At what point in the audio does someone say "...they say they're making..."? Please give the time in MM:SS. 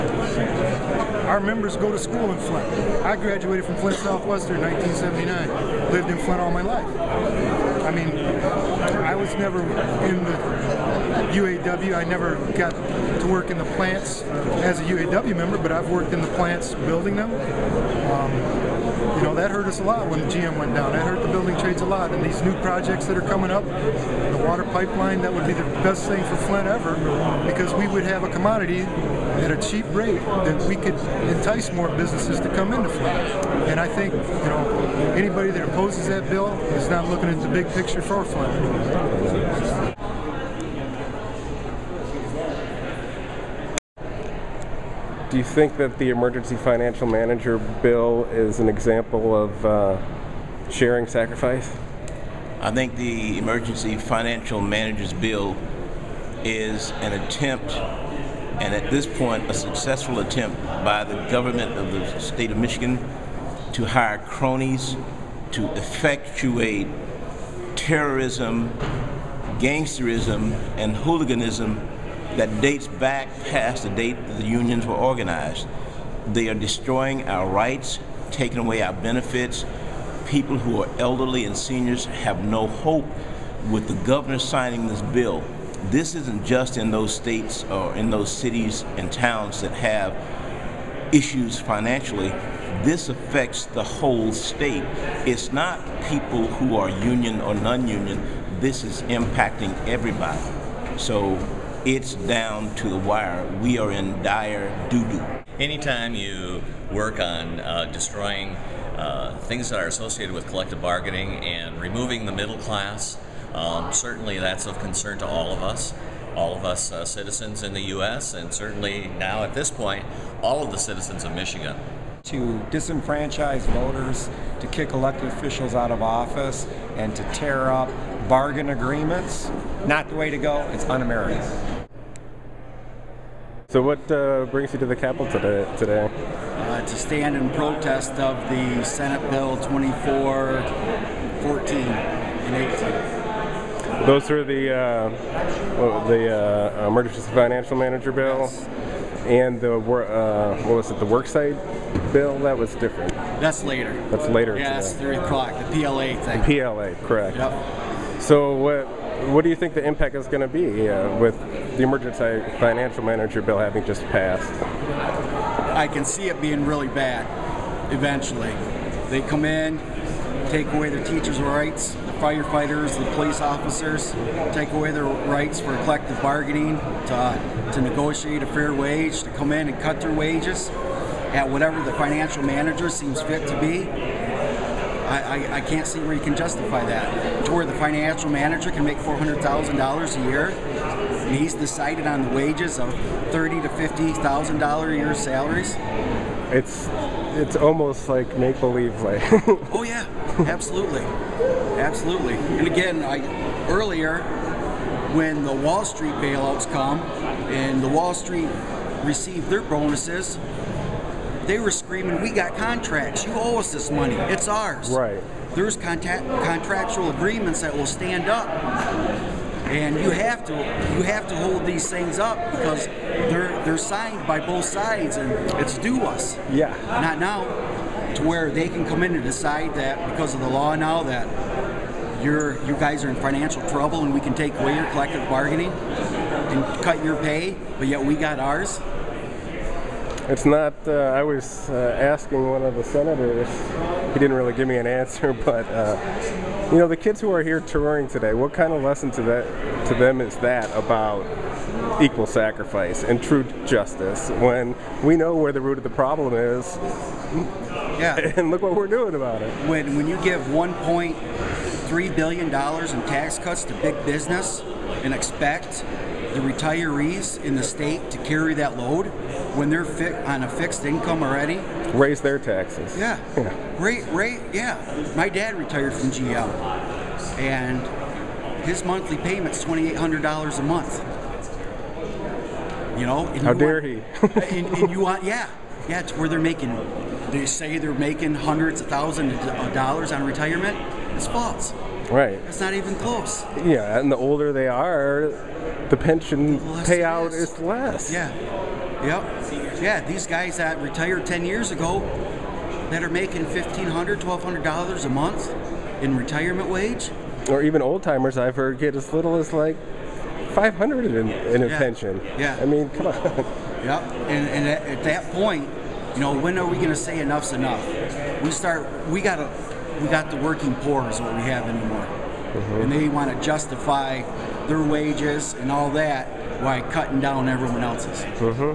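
04:47.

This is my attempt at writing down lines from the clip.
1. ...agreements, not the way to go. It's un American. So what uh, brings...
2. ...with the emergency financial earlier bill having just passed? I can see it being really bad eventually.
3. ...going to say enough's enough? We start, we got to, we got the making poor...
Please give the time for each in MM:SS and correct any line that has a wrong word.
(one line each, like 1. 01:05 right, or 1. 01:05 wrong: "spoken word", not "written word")
1. 02:08 right
2. 02:41 wrong: "manager", not "earlier"
3. 05:16 wrong: "working", not "making".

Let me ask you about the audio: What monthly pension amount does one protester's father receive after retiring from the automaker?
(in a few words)
$2,800.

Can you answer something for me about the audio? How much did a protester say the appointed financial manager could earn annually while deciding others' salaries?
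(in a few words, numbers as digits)
$400,000.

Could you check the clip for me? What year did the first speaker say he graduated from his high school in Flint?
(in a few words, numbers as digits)
1979.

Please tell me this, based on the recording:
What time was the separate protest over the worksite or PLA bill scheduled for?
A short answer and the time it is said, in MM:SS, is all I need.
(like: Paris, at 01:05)
3 o'clock, at 02:34.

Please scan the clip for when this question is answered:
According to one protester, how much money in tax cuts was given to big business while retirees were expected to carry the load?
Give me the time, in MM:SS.
04:20.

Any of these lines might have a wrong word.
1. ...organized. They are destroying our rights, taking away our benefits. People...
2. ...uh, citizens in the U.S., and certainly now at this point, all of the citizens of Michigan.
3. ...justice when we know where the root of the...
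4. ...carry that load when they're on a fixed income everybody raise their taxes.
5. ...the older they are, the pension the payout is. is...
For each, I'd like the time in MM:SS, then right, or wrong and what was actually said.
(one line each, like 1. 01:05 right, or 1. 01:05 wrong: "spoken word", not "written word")
1. 01:14 right
2. 01:56 right
3. 04:13 right
4. 04:28 wrong: "already", not "everybody"
5. 04:54 right.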